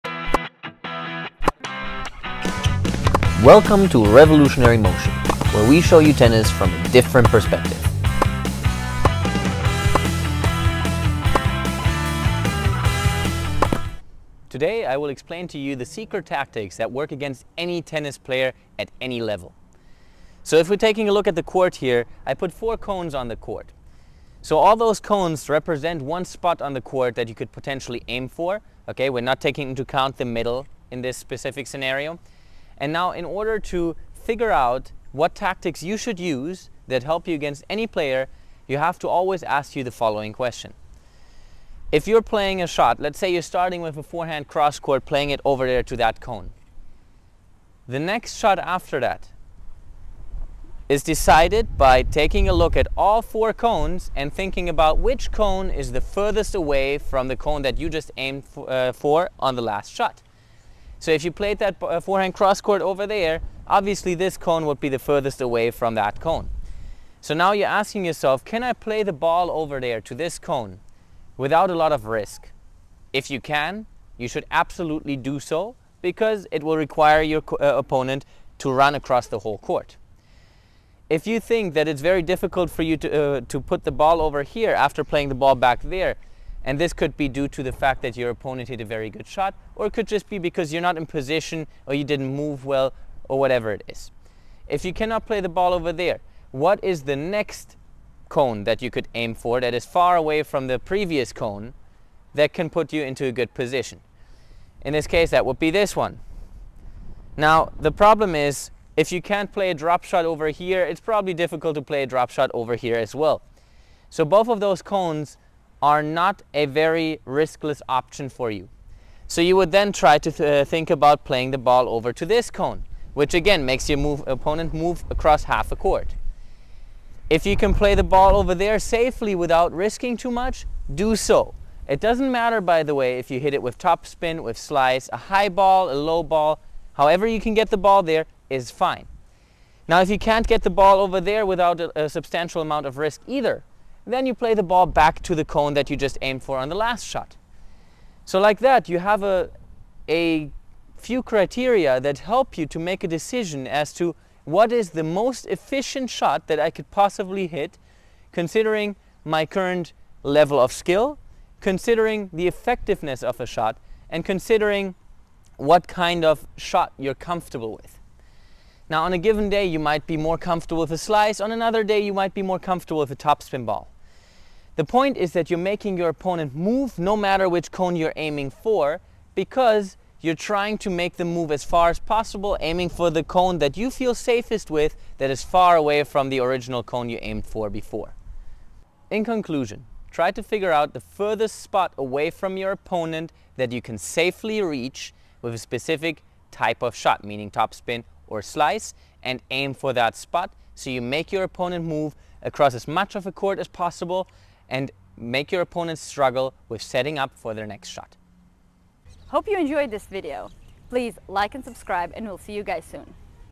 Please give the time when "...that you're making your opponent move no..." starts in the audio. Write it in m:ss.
2:55.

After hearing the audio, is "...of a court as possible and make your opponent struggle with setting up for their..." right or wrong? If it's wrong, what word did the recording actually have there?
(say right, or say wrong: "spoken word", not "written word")
right.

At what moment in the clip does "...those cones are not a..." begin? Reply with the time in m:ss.
1:54.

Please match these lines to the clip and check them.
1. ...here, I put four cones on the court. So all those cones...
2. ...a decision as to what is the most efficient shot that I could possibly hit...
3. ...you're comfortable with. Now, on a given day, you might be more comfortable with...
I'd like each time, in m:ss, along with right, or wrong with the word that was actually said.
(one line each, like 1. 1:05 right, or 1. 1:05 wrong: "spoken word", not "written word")
1. 0:21 right
2. 2:33 right
3. 2:46 right.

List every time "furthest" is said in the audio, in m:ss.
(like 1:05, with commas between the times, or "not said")
0:56, 1:04, 3:10.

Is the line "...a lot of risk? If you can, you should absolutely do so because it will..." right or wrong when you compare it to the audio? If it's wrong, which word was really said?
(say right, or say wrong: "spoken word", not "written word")
right.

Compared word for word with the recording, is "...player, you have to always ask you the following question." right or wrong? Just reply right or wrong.
right.